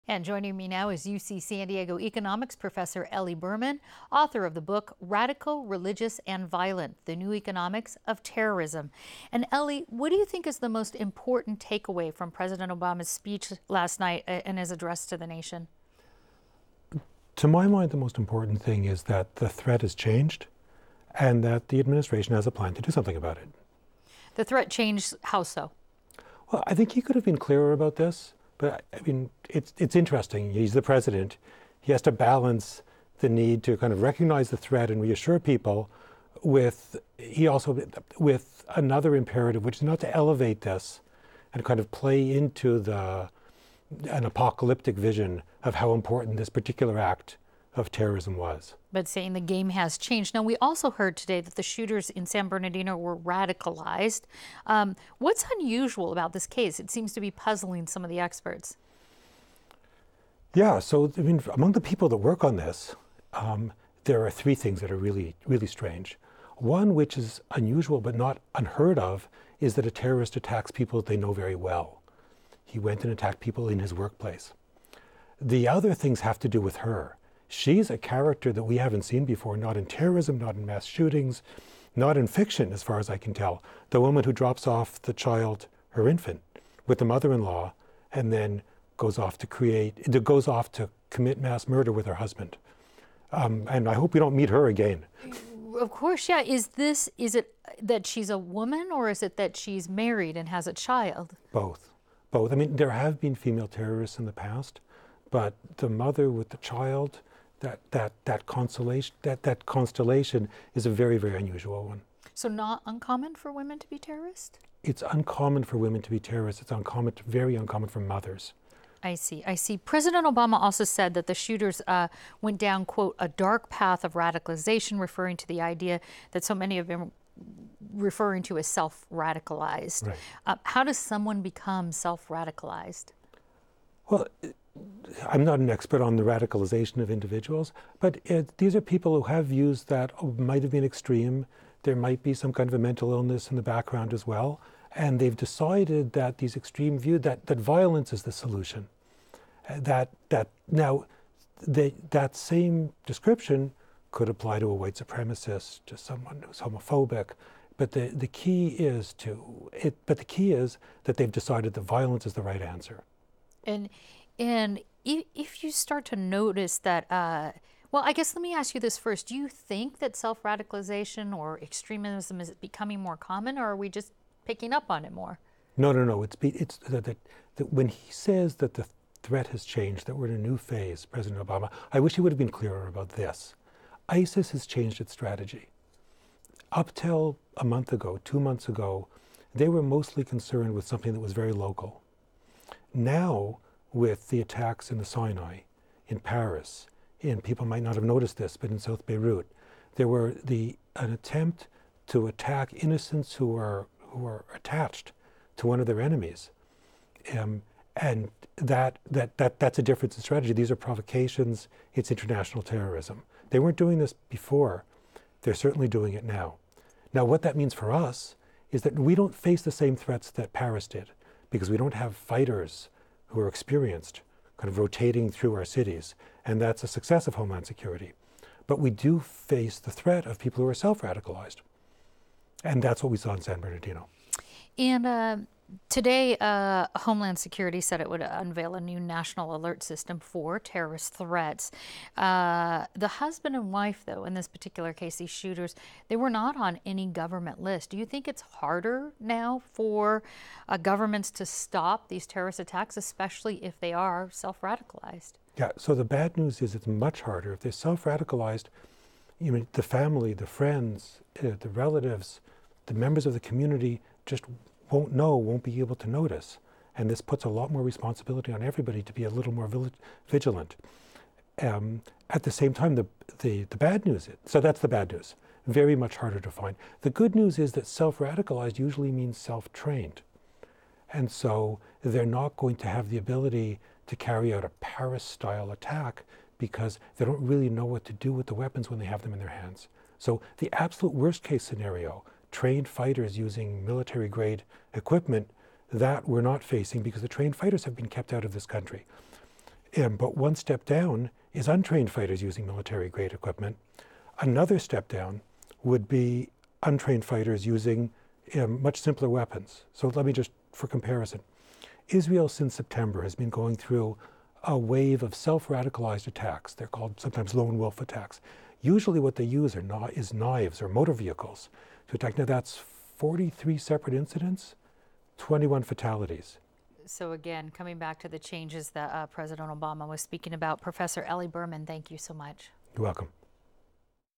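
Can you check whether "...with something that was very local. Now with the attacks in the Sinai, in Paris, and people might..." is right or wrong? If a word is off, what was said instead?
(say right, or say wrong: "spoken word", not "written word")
right.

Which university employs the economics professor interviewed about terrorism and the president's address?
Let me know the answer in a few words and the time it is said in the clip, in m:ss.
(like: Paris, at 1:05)
UC San Diego, at 0:01.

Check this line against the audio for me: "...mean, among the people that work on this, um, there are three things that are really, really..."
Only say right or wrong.
right.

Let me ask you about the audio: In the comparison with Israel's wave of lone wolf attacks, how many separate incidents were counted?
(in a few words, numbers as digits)
43.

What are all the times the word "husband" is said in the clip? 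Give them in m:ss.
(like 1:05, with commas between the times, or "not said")
1:32, 4:03.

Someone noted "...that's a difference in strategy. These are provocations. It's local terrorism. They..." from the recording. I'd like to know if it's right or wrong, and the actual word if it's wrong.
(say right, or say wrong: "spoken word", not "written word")
wrong: "international", not "local".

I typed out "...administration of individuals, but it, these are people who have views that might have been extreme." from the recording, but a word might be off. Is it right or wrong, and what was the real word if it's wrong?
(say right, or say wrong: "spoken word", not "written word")
wrong: "radicalization", not "administration".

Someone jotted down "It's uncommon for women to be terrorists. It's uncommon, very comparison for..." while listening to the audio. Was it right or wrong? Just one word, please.
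wrong.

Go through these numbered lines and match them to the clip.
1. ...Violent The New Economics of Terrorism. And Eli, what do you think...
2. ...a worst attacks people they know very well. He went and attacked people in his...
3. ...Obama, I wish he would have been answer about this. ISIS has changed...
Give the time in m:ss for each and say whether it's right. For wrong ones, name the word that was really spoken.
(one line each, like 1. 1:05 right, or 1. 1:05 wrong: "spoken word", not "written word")
1. 0:06 right
2. 1:09 wrong: "terrorist", not "worst"
3. 3:01 wrong: "clearer", not "answer".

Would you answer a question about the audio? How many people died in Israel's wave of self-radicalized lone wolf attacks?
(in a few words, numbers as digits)
21.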